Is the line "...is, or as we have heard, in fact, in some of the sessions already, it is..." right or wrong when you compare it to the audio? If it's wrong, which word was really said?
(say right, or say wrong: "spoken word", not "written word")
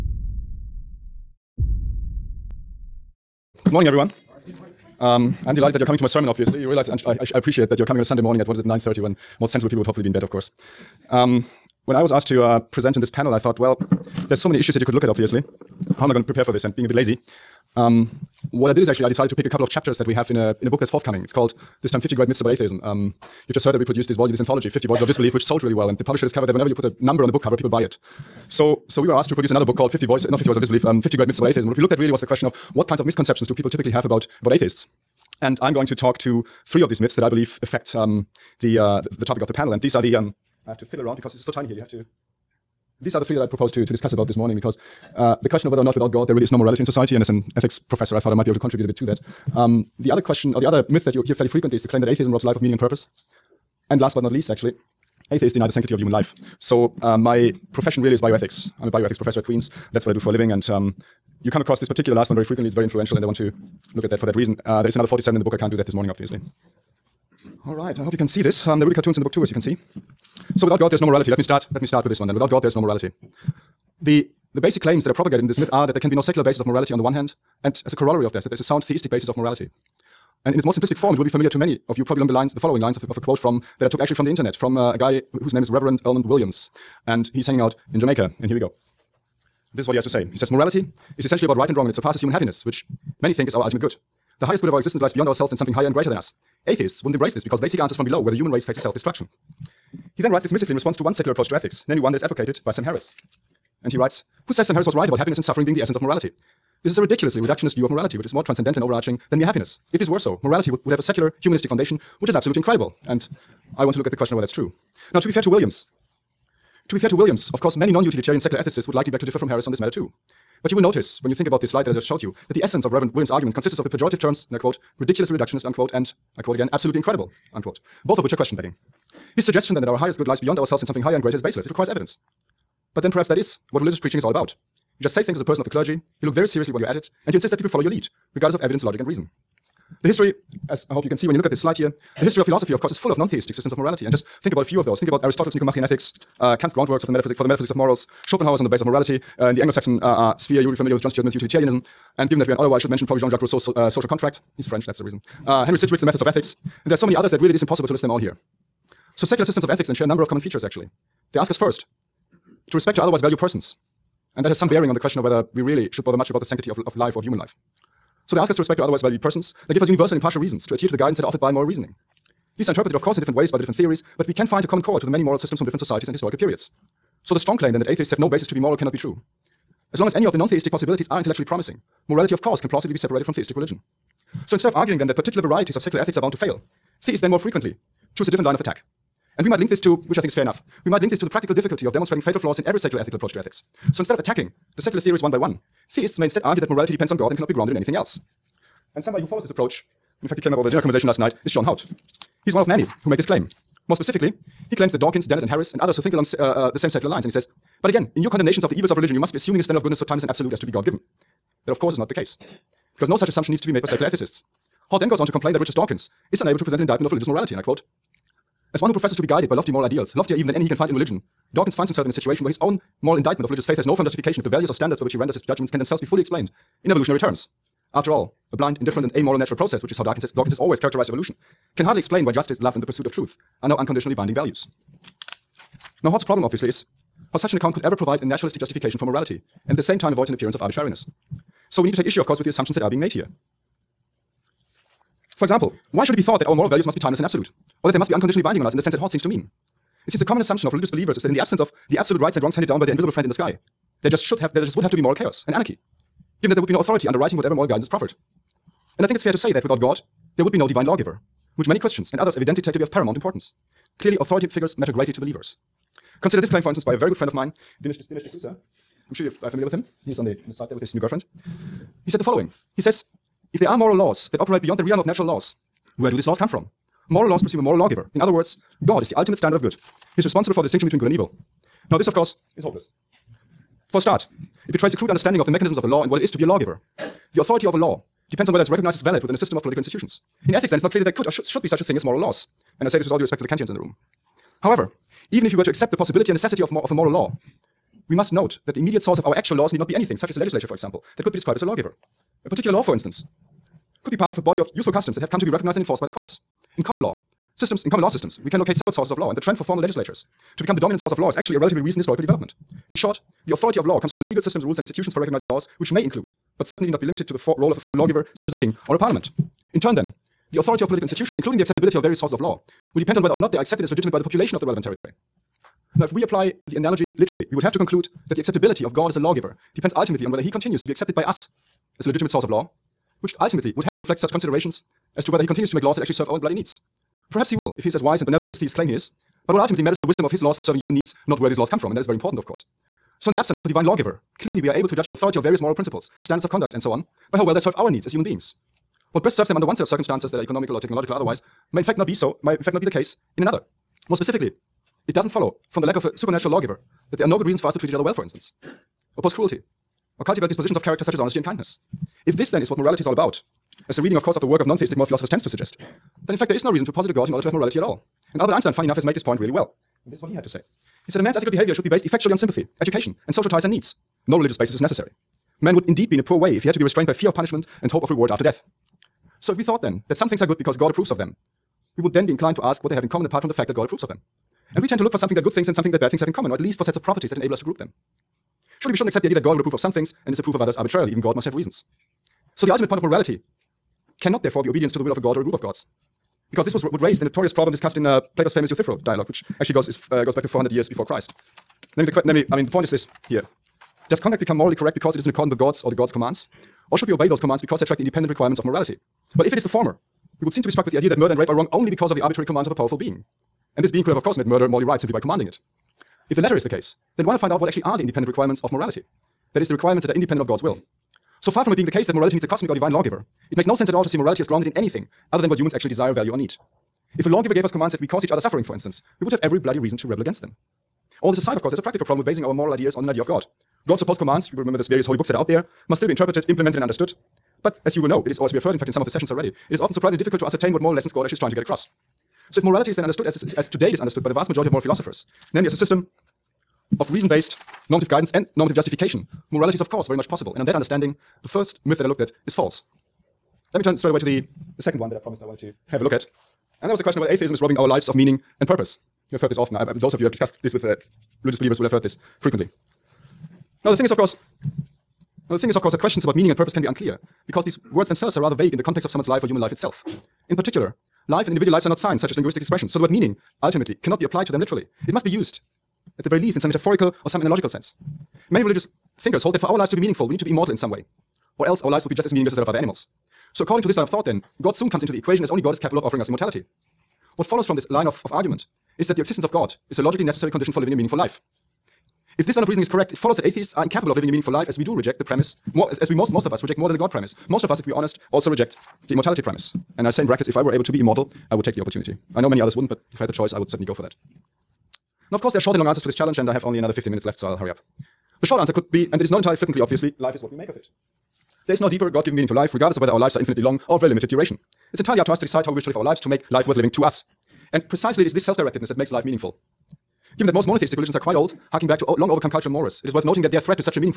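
right.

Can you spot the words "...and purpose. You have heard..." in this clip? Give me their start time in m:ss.
7:38.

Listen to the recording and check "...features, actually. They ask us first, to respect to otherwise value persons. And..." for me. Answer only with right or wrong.
right.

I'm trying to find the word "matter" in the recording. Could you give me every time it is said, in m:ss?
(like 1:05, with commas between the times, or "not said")
1:59, 4:24, 5:39.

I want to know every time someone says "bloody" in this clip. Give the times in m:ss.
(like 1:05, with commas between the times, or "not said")
5:36, 7:09.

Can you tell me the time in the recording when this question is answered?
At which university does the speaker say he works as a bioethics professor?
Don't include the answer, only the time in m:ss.
0:59.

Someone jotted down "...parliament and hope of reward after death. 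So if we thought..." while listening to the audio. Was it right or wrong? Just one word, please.
wrong.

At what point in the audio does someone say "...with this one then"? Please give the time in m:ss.
1:12.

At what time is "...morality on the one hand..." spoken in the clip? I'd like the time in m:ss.
1:16.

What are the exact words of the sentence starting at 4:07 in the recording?
or that they must be unconditionally binding on us in the sense that Haught seems to mean.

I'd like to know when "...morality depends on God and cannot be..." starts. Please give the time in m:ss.
3:16.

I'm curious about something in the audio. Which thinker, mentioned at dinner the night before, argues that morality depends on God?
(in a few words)
John Haught.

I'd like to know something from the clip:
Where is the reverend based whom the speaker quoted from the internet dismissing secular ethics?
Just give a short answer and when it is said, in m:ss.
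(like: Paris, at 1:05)
Jamaica, at 1:27.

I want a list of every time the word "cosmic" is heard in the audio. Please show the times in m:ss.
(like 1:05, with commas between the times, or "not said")
7:02.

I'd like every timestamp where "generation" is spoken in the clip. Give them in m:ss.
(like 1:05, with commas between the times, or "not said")
not said.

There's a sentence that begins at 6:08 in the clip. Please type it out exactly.
And Albert Einstein, funny enough, has made this point really well.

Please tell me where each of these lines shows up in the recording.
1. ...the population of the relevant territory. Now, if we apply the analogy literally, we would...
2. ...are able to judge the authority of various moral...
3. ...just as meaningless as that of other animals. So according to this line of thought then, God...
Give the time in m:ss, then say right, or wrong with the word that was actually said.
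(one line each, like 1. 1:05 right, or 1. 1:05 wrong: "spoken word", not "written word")
1. 5:24 right
2. 5:44 right
3. 8:02 right.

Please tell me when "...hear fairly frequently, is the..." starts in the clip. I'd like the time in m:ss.
0:51.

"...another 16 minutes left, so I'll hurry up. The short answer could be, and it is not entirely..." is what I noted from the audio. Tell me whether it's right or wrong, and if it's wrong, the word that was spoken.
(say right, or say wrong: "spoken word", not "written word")
wrong: "15", not "16".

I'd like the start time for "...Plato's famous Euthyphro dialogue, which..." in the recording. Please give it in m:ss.
6:38.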